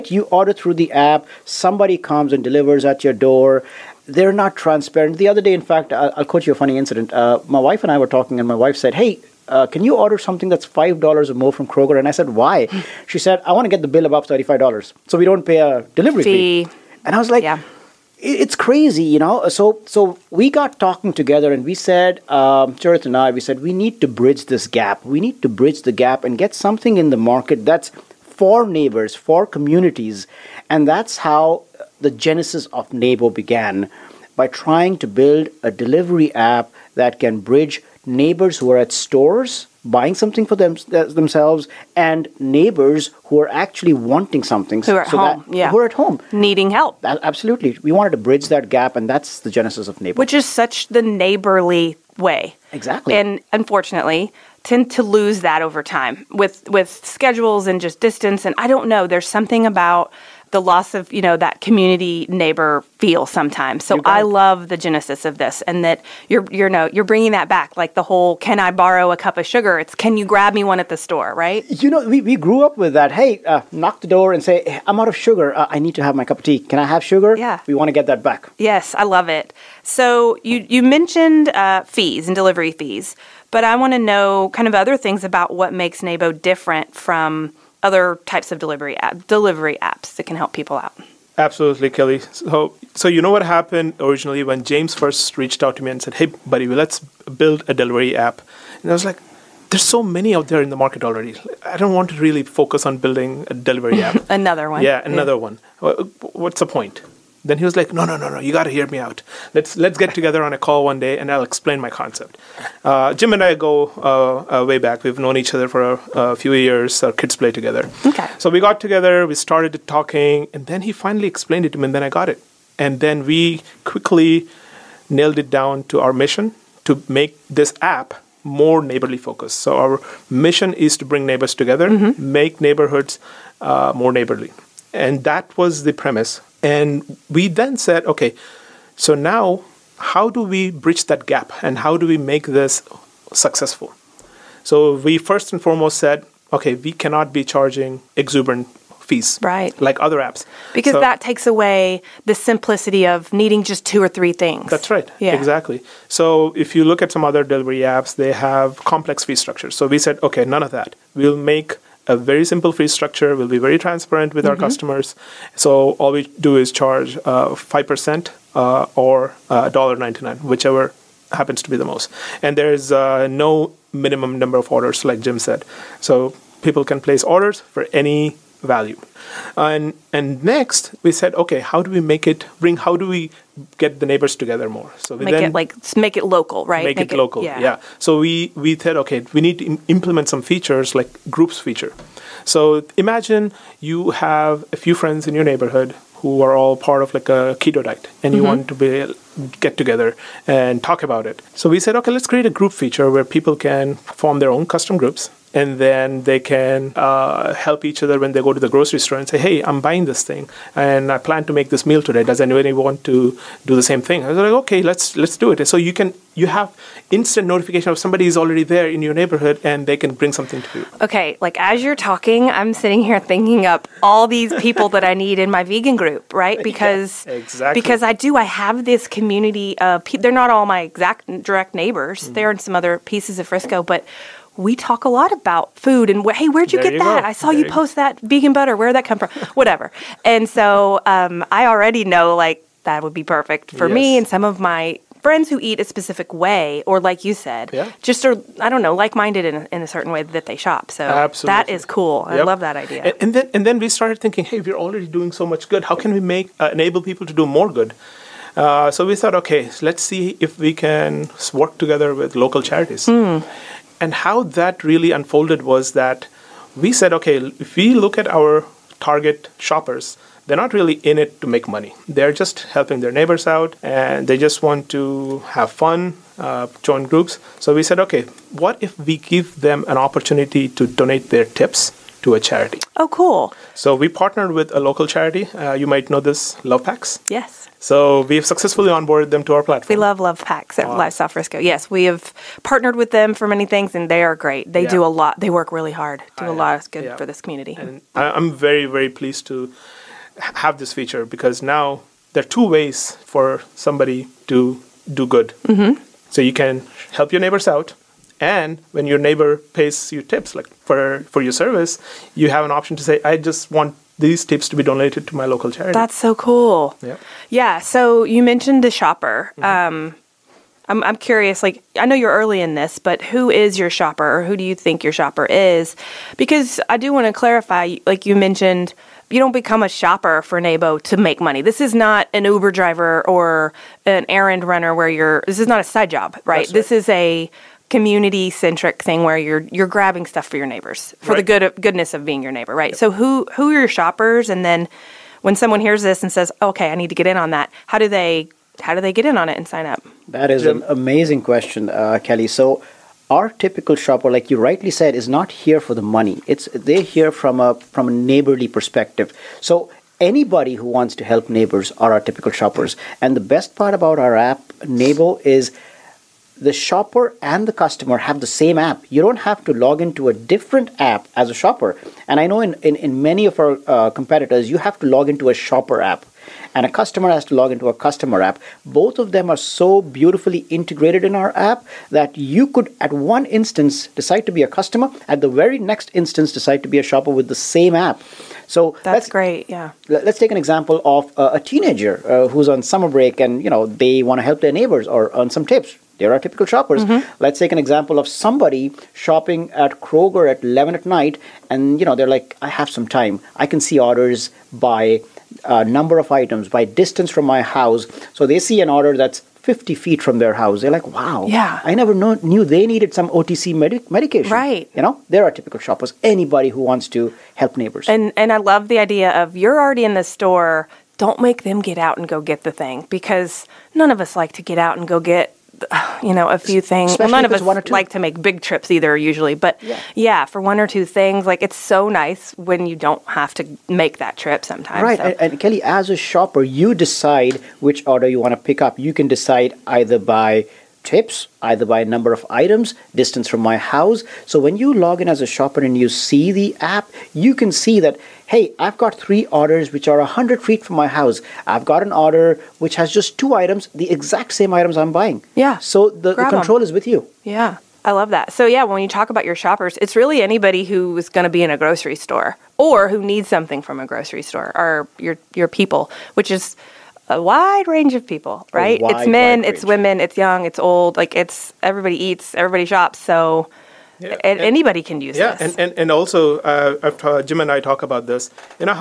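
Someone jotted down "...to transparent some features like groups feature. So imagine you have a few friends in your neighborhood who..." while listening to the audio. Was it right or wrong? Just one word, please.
wrong.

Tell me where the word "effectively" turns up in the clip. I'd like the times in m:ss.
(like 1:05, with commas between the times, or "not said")
not said.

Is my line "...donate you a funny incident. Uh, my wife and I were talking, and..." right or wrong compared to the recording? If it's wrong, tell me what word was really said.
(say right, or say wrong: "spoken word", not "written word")
wrong: "quote", not "donate".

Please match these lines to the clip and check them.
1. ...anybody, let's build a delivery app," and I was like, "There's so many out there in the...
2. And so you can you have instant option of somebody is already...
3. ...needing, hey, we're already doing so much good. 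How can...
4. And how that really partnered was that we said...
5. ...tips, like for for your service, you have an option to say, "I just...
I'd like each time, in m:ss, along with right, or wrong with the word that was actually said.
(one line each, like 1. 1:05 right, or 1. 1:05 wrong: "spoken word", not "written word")
1. 1:36 wrong: "buddy", not "anybody"
2. 3:35 wrong: "notification", not "option"
3. 4:14 wrong: "thinking", not "needing"
4. 4:24 wrong: "unfolded", not "partnered"
5. 5:10 right.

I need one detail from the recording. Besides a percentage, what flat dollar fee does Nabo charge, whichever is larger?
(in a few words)
$1.99.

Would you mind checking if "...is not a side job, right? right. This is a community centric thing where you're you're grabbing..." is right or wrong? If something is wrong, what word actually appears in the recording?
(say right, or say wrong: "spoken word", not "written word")
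right.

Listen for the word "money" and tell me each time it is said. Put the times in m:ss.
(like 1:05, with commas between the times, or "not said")
4:31, 5:31, 5:56.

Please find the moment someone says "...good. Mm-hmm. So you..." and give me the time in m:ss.
5:05.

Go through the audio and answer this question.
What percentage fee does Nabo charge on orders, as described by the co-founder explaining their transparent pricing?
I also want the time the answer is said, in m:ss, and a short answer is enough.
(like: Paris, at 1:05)
5%, at 2:47.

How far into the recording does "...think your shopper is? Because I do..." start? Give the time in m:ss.
5:24.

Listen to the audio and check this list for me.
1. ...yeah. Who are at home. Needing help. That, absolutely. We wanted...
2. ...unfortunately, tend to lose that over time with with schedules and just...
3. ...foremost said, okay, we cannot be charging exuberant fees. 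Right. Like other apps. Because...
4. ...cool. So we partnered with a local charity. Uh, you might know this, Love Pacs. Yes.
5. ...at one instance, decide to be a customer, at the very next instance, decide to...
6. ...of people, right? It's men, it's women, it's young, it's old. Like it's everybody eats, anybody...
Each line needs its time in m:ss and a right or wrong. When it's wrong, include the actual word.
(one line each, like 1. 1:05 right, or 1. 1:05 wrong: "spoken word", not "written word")
1. 0:45 right
2. 0:53 right
3. 2:25 right
4. 4:43 right
5. 6:23 right
6. 7:48 wrong: "everybody", not "anybody".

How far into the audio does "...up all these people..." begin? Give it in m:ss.
3:43.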